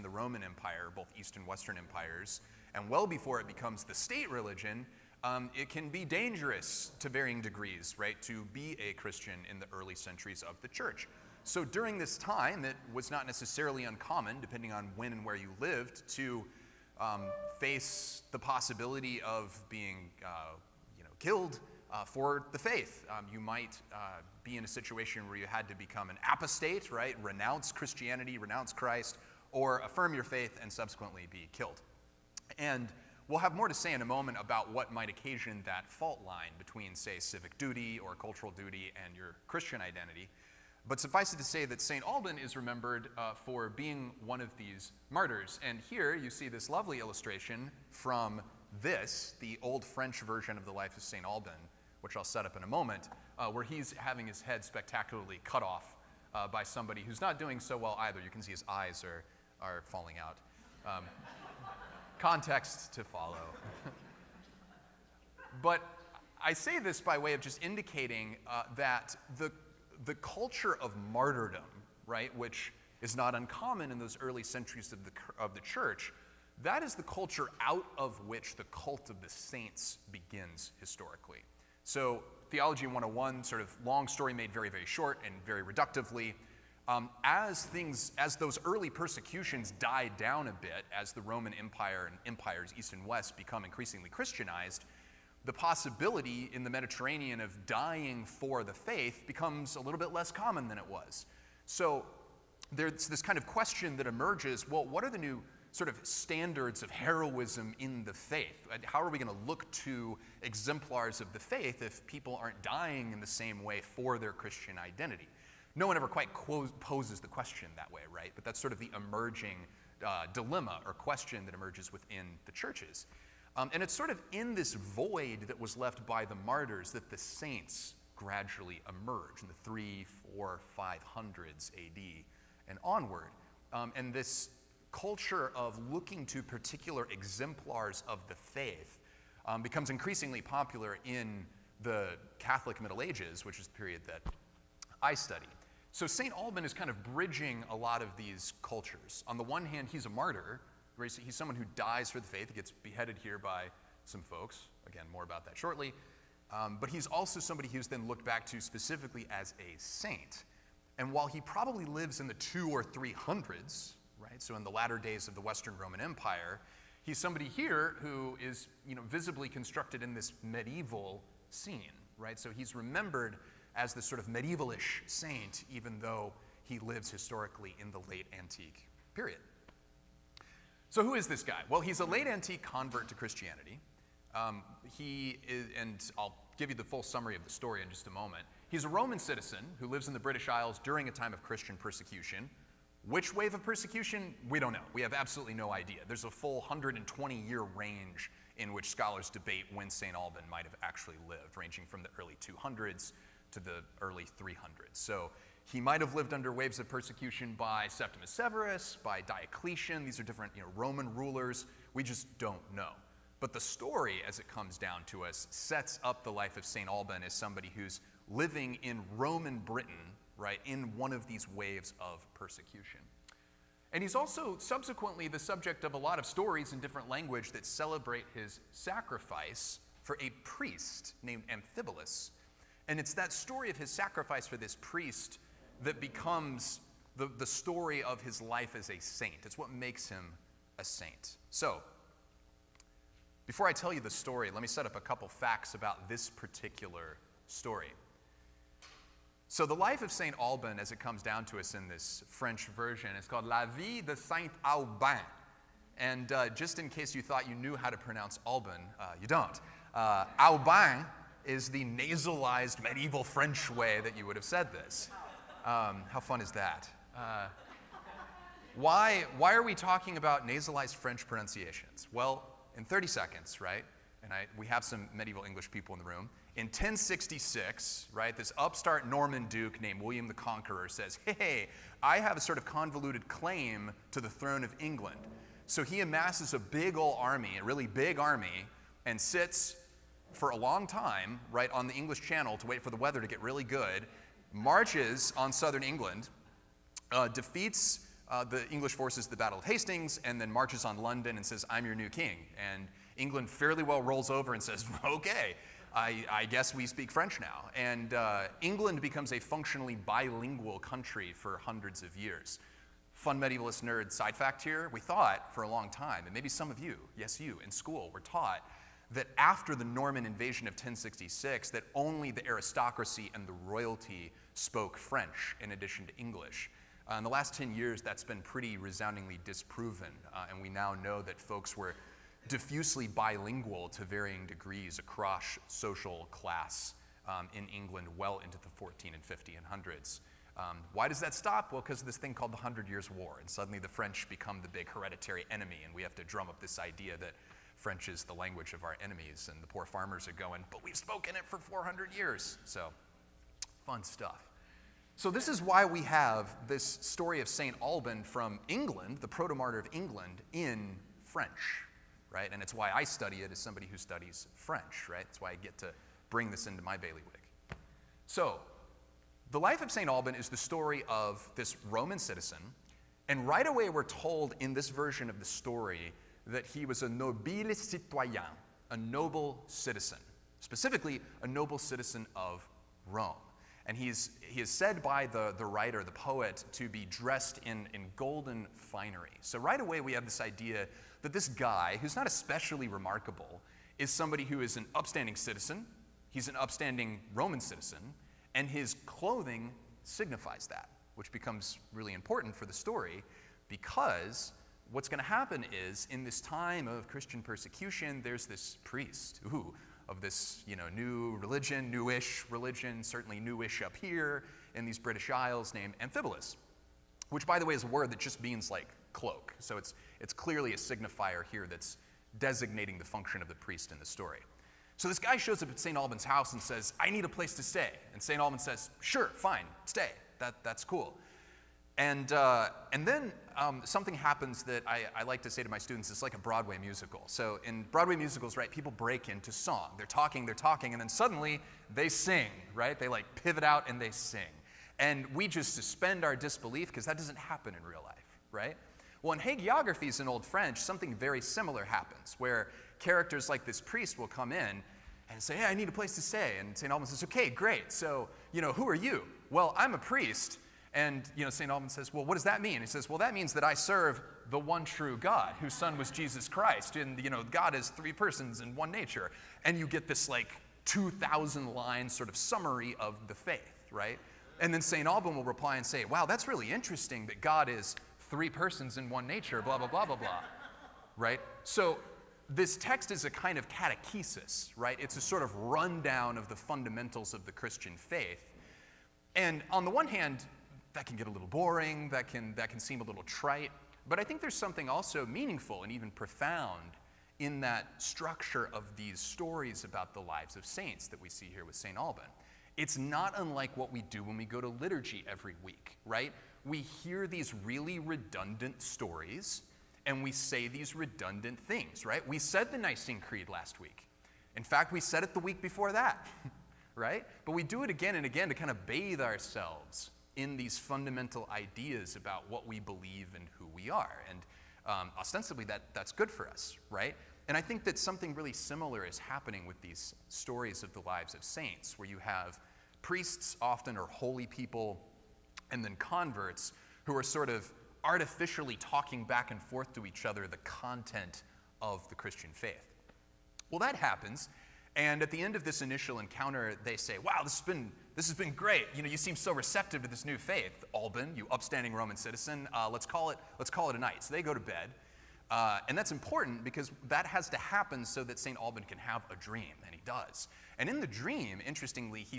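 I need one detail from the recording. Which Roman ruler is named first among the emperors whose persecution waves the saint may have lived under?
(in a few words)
Septimus Severus.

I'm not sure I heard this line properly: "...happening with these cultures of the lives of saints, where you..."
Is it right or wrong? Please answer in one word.
wrong.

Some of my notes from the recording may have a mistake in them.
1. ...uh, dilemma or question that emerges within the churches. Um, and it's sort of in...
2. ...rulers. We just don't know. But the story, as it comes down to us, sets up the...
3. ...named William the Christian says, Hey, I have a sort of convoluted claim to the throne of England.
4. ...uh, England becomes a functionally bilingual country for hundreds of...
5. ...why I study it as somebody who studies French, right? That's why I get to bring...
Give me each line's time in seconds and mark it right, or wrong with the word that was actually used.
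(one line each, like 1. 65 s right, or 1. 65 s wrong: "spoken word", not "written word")
1. 120 s right
2. 211 s right
3. 279 s wrong: "Conqueror", not "Christian"
4. 308 s right
5. 362 s right.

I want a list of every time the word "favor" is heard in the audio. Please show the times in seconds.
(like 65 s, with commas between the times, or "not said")
not said.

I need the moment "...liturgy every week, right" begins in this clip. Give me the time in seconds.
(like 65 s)
504 s.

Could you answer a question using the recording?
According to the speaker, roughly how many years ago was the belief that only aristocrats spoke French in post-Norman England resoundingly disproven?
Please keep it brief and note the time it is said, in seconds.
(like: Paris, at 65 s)
10, at 327 s.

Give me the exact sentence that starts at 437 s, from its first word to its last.
So in Broadway musicals, right, people break into song.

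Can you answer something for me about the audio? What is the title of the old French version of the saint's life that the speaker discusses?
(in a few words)
La Vie de Saint Alban.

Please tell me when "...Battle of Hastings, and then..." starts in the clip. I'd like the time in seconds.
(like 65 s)
299 s.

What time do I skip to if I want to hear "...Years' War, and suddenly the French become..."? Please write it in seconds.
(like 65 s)
342 s.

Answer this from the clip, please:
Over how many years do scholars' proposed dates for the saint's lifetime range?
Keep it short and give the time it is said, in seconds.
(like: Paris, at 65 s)
120, at 196 s.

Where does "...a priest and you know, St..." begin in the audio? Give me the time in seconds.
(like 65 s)
459 s.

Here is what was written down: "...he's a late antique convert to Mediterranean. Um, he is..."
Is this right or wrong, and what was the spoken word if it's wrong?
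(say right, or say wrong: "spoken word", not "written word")
wrong: "Christianity", not "Mediterranean".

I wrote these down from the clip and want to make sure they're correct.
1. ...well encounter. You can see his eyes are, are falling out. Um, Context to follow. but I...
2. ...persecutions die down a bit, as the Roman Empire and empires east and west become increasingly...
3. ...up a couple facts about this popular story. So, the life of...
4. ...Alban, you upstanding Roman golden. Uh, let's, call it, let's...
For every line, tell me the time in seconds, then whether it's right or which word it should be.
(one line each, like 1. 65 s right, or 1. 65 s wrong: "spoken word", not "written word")
1. 57 s wrong: "either", not "encounter"
2. 88 s right
3. 244 s wrong: "particular", not "popular"
4. 550 s wrong: "citizen", not "golden".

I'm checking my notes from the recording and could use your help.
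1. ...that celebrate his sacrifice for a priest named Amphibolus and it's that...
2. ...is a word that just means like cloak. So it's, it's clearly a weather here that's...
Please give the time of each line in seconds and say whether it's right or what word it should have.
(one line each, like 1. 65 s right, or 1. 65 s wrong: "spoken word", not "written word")
1. 227 s right
2. 417 s wrong: "signifier", not "weather".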